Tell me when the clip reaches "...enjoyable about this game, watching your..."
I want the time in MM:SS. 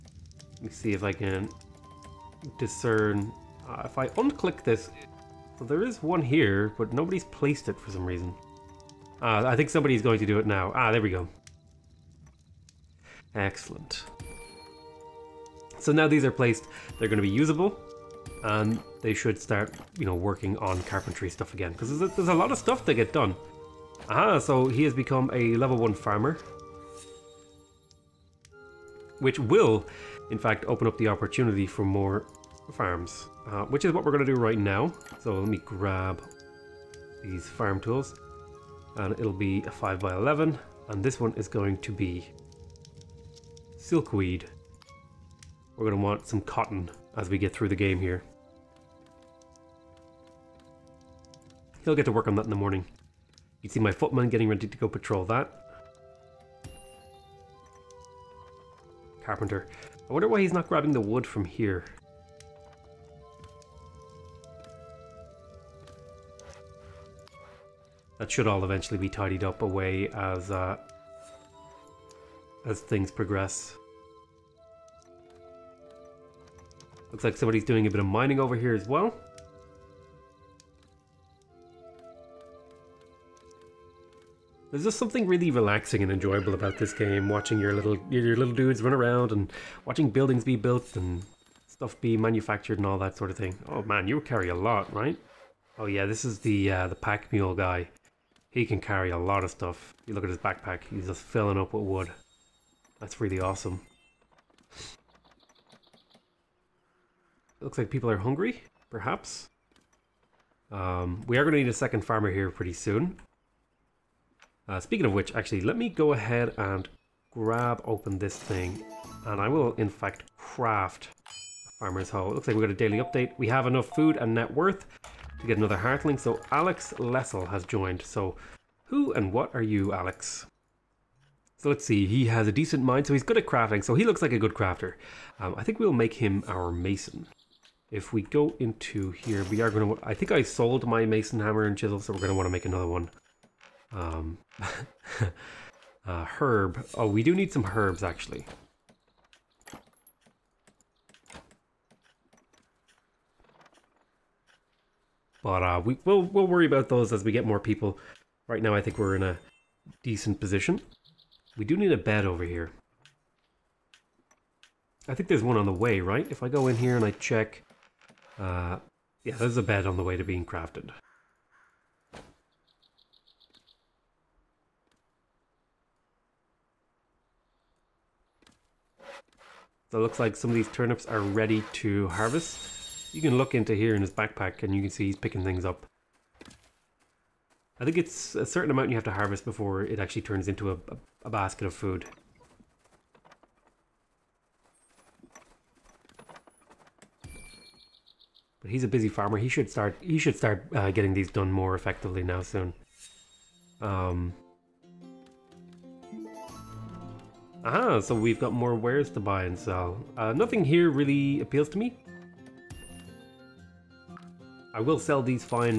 01:26.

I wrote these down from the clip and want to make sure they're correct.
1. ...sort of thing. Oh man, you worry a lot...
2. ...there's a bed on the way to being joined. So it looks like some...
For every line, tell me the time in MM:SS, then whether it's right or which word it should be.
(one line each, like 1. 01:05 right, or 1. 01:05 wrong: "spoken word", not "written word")
1. 01:33 wrong: "carry", not "worry"
2. 02:49 wrong: "crafted", not "joined".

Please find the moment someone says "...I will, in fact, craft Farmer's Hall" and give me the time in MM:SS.
01:59.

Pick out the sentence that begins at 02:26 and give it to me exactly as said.
Oh, we do need some herbs, actually.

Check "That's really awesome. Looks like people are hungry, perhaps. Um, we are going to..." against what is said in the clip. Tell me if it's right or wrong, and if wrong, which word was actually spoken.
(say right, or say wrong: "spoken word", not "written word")
right.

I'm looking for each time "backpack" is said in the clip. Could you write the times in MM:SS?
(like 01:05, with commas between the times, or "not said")
01:40, 03:04.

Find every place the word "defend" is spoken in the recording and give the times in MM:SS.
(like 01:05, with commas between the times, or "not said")
not said.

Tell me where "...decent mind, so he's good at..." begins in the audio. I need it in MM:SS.
02:12.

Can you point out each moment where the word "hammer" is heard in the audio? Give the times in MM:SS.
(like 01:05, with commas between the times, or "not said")
02:21.